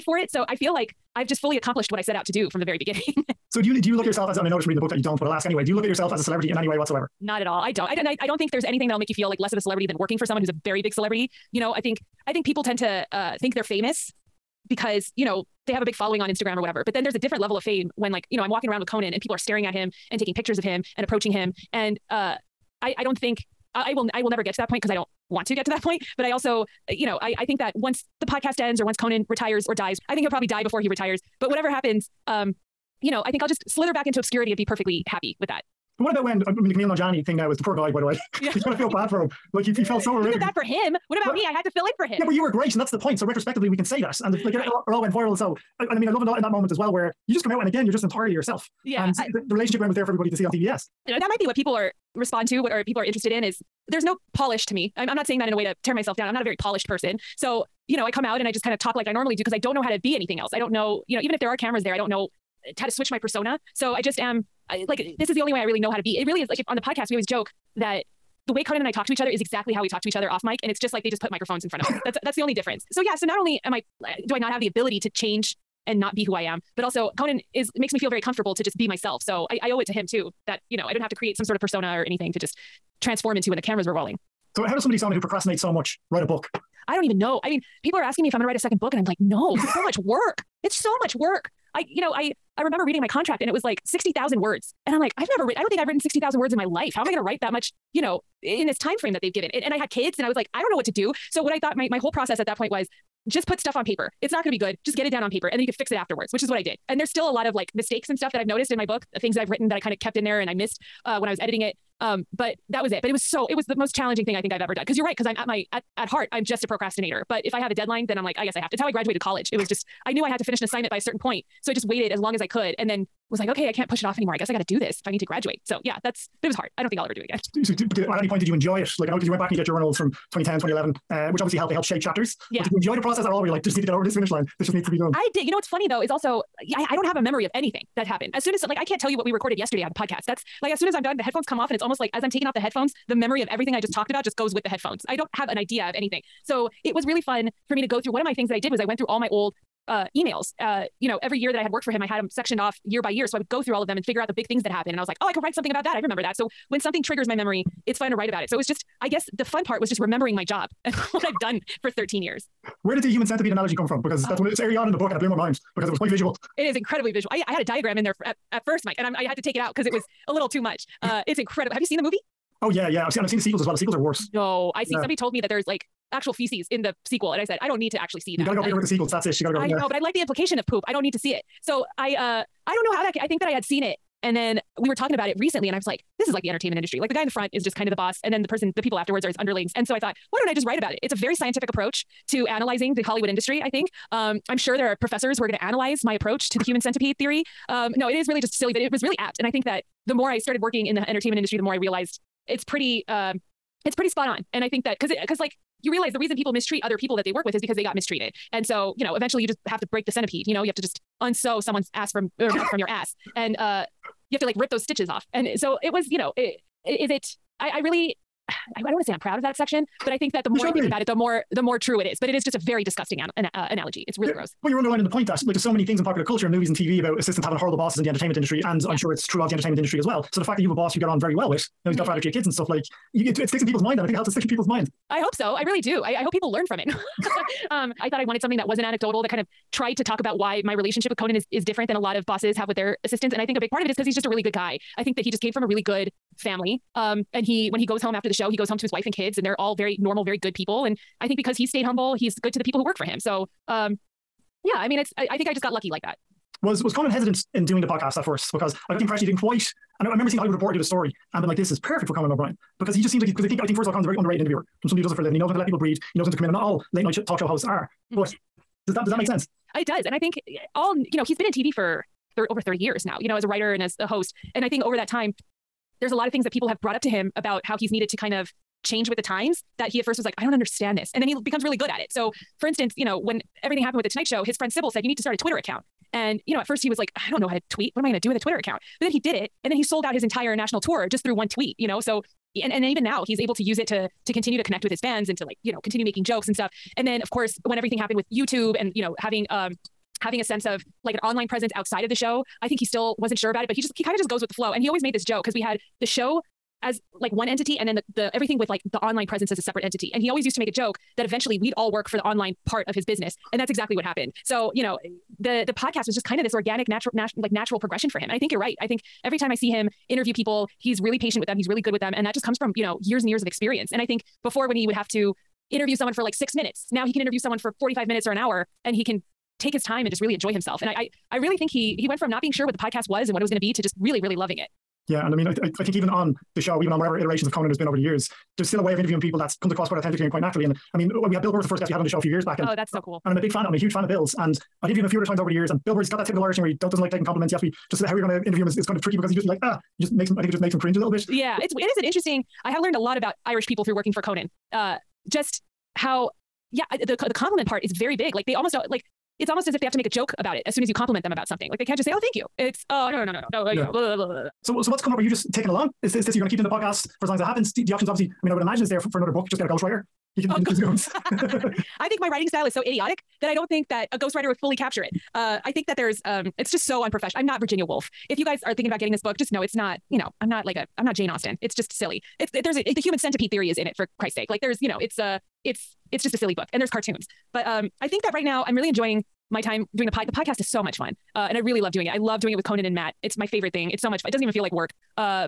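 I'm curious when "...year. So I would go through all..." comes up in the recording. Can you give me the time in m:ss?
2:33.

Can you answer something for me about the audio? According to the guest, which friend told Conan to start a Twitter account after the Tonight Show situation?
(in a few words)
Sybil.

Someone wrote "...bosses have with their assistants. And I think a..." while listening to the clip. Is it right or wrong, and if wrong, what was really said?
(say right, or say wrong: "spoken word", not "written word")
right.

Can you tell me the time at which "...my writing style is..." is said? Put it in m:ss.
6:12.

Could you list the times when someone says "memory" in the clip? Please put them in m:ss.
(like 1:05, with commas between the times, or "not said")
2:17, 2:23, 2:37.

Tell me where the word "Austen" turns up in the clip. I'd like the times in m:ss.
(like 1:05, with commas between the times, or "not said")
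6:21.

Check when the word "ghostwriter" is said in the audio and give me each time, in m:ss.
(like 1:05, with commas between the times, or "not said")
6:09, 6:14.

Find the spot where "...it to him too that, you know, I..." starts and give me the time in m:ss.
1:19.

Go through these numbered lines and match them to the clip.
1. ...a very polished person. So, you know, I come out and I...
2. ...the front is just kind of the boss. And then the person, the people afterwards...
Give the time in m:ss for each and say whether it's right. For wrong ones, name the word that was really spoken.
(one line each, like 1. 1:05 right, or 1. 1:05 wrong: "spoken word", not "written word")
1. 0:56 right
2. 3:07 right.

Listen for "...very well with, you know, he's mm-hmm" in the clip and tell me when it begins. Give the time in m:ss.
3:51.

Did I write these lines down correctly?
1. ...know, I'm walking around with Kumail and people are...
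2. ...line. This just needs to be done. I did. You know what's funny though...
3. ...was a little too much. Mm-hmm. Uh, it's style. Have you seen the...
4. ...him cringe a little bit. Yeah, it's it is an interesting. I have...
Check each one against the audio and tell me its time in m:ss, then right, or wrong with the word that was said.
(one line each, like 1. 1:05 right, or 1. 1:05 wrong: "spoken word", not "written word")
1. 0:18 wrong: "Conan", not "Kumail"
2. 2:14 right
3. 2:49 wrong: "incredible", not "style"
4. 5:50 right.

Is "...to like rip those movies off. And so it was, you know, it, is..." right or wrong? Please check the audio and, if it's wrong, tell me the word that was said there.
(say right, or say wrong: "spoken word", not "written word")
wrong: "stitches", not "movies".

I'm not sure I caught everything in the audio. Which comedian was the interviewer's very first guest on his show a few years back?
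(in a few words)
Bill Burr.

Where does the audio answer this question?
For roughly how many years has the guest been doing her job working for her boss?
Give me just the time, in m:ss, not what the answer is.
2:41.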